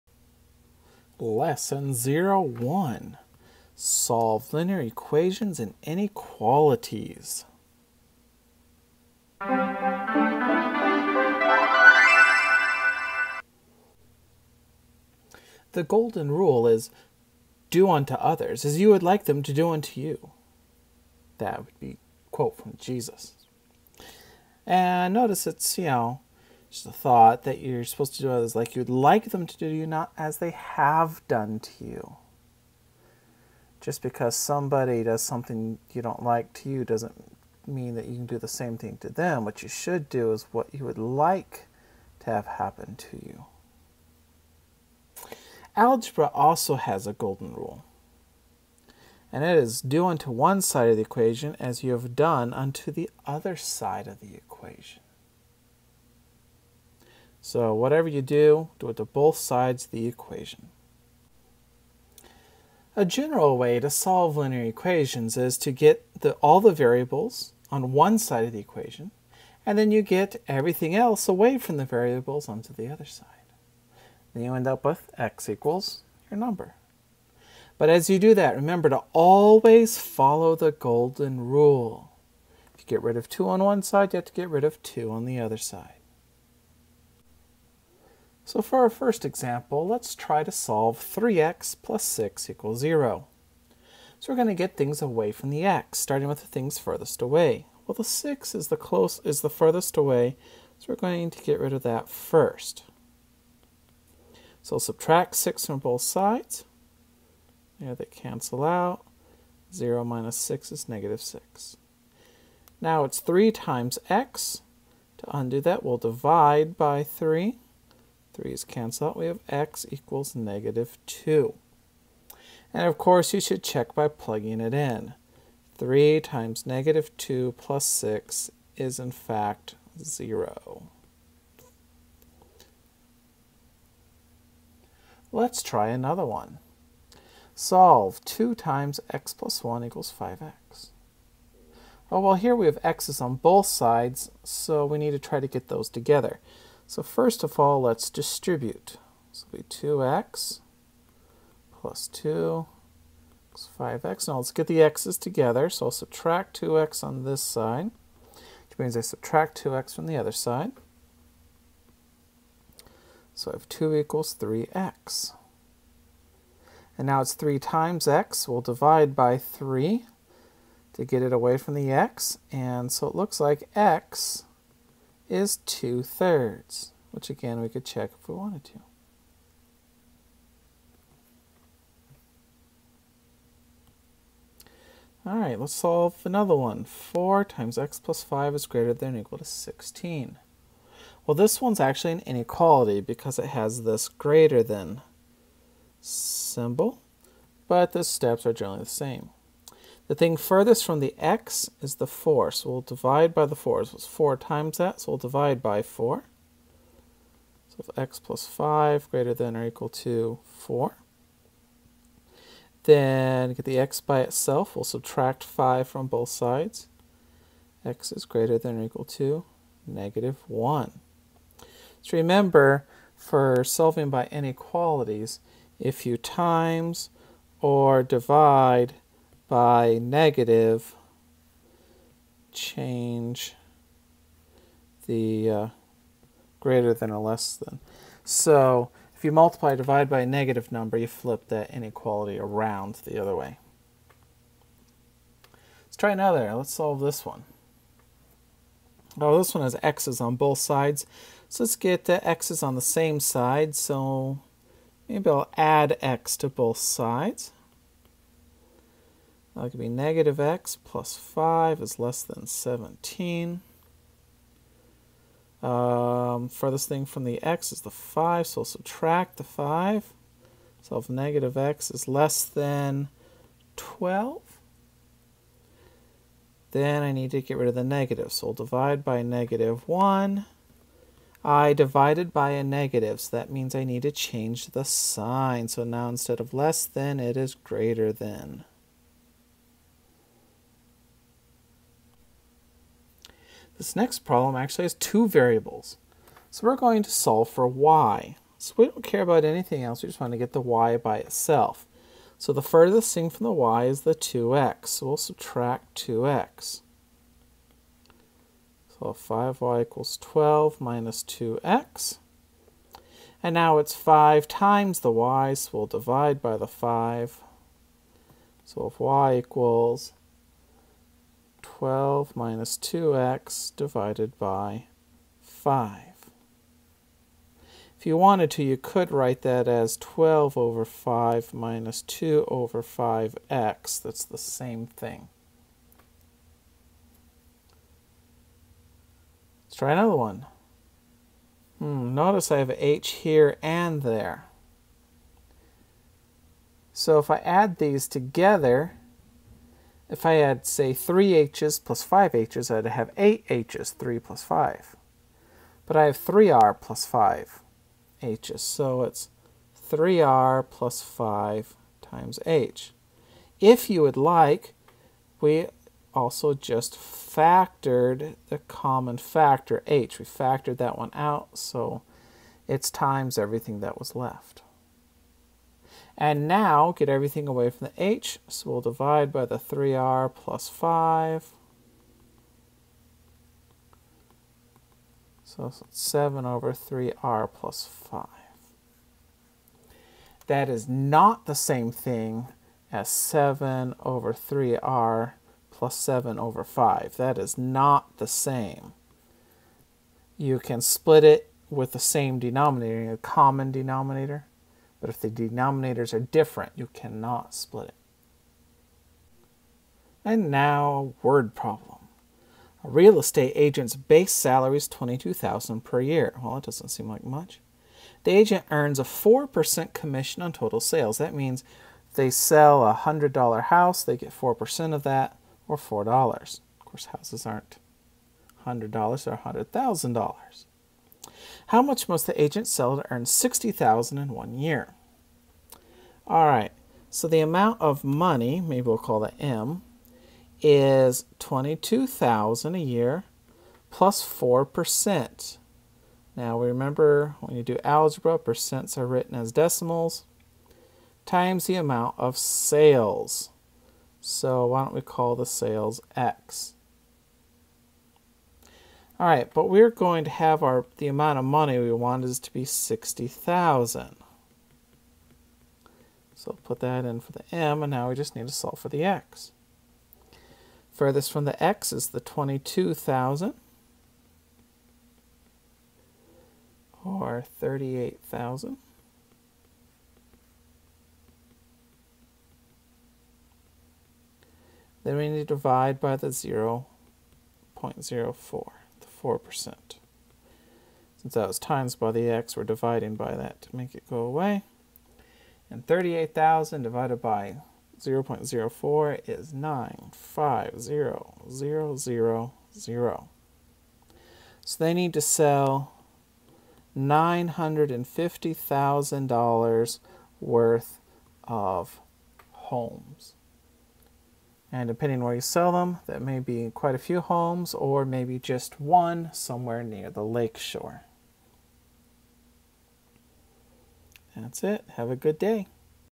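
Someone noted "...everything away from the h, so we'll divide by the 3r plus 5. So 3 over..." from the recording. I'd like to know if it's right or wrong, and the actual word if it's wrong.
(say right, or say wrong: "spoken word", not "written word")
wrong: "7", not "3".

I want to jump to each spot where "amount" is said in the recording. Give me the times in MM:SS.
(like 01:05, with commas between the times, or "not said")
07:17, 07:31, 07:41.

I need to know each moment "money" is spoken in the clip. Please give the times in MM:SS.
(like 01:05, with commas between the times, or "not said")
07:18, 07:41.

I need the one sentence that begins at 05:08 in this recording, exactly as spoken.
So 5y equals 12 minus 2x.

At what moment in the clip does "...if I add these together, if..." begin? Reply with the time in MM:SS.
05:47.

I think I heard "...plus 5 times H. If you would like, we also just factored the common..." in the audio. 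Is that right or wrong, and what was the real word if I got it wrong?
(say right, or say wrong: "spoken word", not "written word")
right.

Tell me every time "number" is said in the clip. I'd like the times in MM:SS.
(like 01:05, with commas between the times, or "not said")
01:16, 04:00.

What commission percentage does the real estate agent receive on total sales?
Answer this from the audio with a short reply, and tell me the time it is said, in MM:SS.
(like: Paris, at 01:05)
4%, at 06:59.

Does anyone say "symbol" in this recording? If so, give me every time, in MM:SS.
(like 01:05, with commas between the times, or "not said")
03:16.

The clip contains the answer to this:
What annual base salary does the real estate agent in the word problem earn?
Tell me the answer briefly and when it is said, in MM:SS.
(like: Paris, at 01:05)
$22,000, at 06:54.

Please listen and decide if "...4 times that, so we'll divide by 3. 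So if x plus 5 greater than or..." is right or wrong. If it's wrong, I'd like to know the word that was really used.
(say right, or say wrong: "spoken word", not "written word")
wrong: "4", not "3".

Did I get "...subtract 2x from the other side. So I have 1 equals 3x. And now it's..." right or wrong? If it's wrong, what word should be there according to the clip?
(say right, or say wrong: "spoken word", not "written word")
wrong: "2", not "1".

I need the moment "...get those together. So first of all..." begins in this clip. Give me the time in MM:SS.
02:25.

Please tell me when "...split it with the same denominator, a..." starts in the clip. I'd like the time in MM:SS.
06:40.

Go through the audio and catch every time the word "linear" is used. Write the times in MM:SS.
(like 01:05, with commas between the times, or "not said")
00:04, 01:04.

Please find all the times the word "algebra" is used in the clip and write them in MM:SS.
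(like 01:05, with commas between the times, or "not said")
00:45, 07:27.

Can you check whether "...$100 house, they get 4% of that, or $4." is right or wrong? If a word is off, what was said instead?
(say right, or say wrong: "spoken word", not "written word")
right.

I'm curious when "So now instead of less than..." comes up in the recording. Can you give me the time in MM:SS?
04:45.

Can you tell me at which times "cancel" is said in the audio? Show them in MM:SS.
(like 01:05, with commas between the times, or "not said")
01:48, 01:58.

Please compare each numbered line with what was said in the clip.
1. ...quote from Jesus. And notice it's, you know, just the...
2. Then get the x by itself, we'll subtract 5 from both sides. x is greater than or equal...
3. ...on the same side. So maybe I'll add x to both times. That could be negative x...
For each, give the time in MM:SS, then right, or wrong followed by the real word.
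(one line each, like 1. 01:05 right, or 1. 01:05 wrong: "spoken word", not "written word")
1. 00:22 right
2. 03:32 right
3. 04:12 wrong: "sides", not "times".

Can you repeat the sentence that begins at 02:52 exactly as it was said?
And so it looks like x is 2 thirds, which again we could check if we wanted to.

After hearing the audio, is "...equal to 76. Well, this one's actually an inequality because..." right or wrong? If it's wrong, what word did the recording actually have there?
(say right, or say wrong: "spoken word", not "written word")
wrong: "16", not "76".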